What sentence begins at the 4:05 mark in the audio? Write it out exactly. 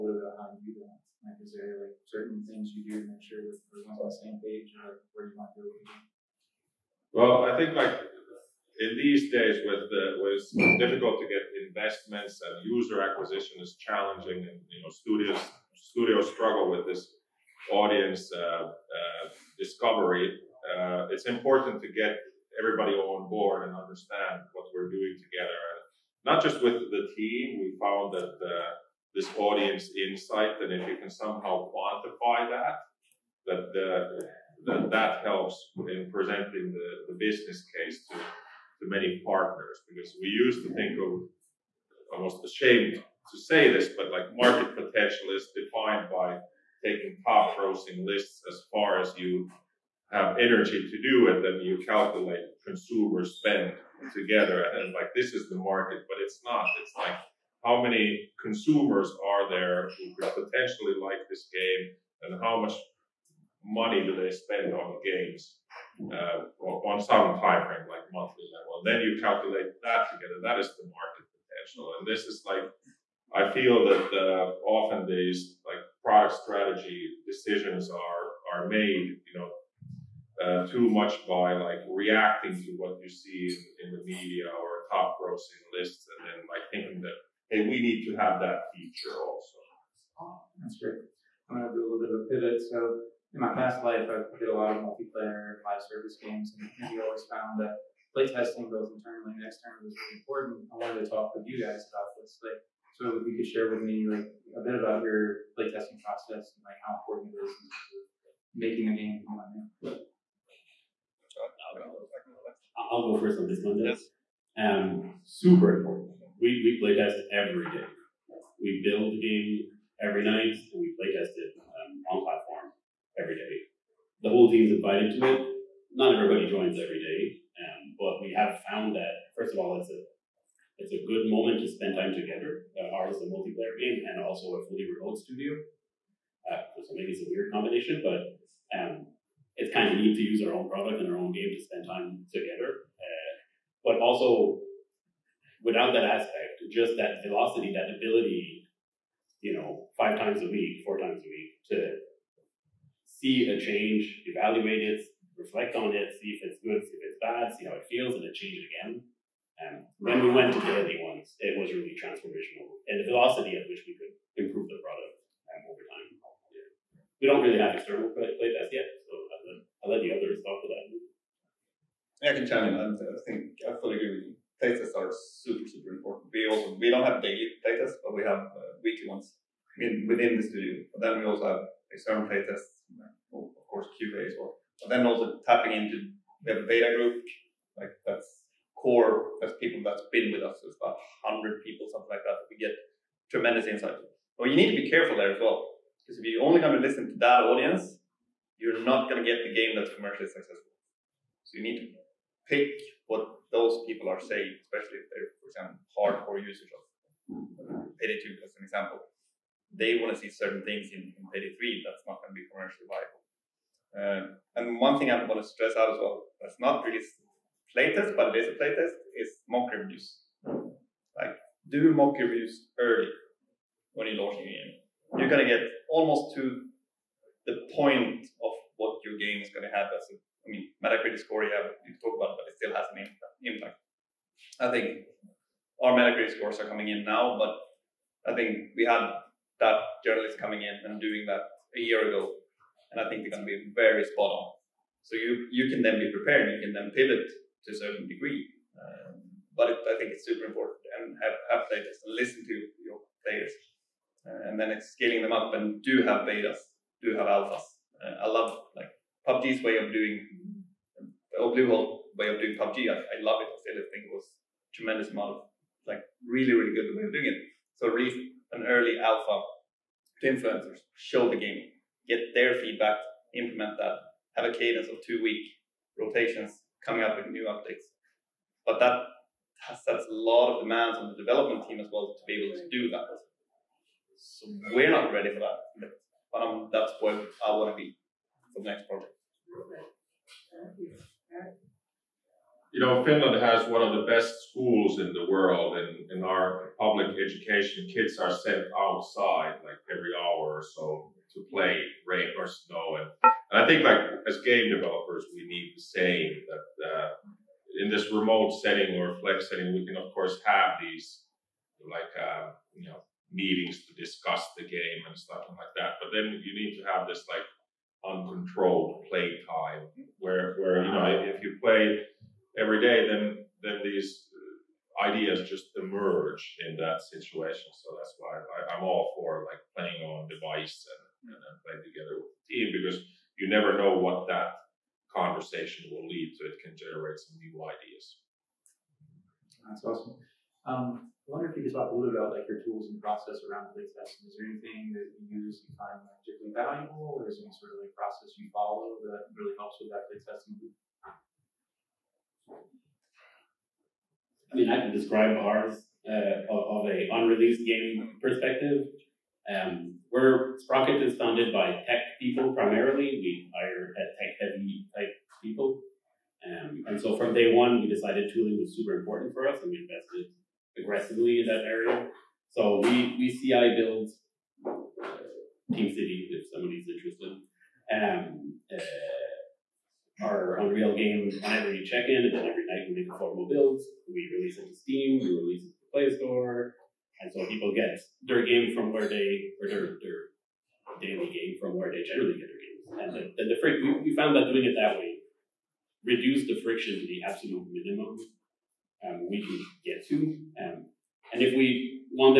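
So you, you can then be prepared, you can then pivot to a certain degree.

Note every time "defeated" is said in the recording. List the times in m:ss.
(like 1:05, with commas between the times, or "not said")
not said.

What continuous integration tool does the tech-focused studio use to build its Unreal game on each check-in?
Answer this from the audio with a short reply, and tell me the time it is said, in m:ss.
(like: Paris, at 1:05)
TeamCity, at 6:15.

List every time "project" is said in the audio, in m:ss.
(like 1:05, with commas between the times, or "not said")
4:48.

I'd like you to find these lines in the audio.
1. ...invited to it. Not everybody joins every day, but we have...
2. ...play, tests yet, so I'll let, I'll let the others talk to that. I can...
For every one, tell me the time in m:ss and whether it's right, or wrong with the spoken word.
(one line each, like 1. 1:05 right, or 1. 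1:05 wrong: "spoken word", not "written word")
1. 2:04 right
2. 2:48 right.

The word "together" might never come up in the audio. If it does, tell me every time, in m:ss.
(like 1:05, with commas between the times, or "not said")
0:25, 0:54, 1:10, 2:12, 2:22, 5:31.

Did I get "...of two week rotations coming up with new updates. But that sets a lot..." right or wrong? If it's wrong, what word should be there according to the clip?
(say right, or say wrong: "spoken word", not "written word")
right.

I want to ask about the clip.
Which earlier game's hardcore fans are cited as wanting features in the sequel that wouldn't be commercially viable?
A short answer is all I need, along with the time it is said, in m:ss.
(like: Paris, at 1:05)
Payday 2, at 3:27.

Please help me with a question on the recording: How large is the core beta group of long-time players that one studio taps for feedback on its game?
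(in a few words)
About 100 people.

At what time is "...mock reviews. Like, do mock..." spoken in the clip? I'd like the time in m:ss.
3:39.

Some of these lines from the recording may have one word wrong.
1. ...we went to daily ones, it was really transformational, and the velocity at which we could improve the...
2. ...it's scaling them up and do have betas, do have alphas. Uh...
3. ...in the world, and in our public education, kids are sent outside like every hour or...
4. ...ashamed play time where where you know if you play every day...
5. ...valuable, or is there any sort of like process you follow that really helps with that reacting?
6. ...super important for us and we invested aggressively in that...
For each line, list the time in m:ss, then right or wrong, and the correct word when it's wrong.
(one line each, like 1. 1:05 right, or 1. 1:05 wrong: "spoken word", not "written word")
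1. 2:40 right
2. 4:14 right
3. 4:54 right
4. 5:18 wrong: "uncontrolled", not "ashamed"
5. 5:46 wrong: "playtesting", not "reacting"
6. 6:08 right.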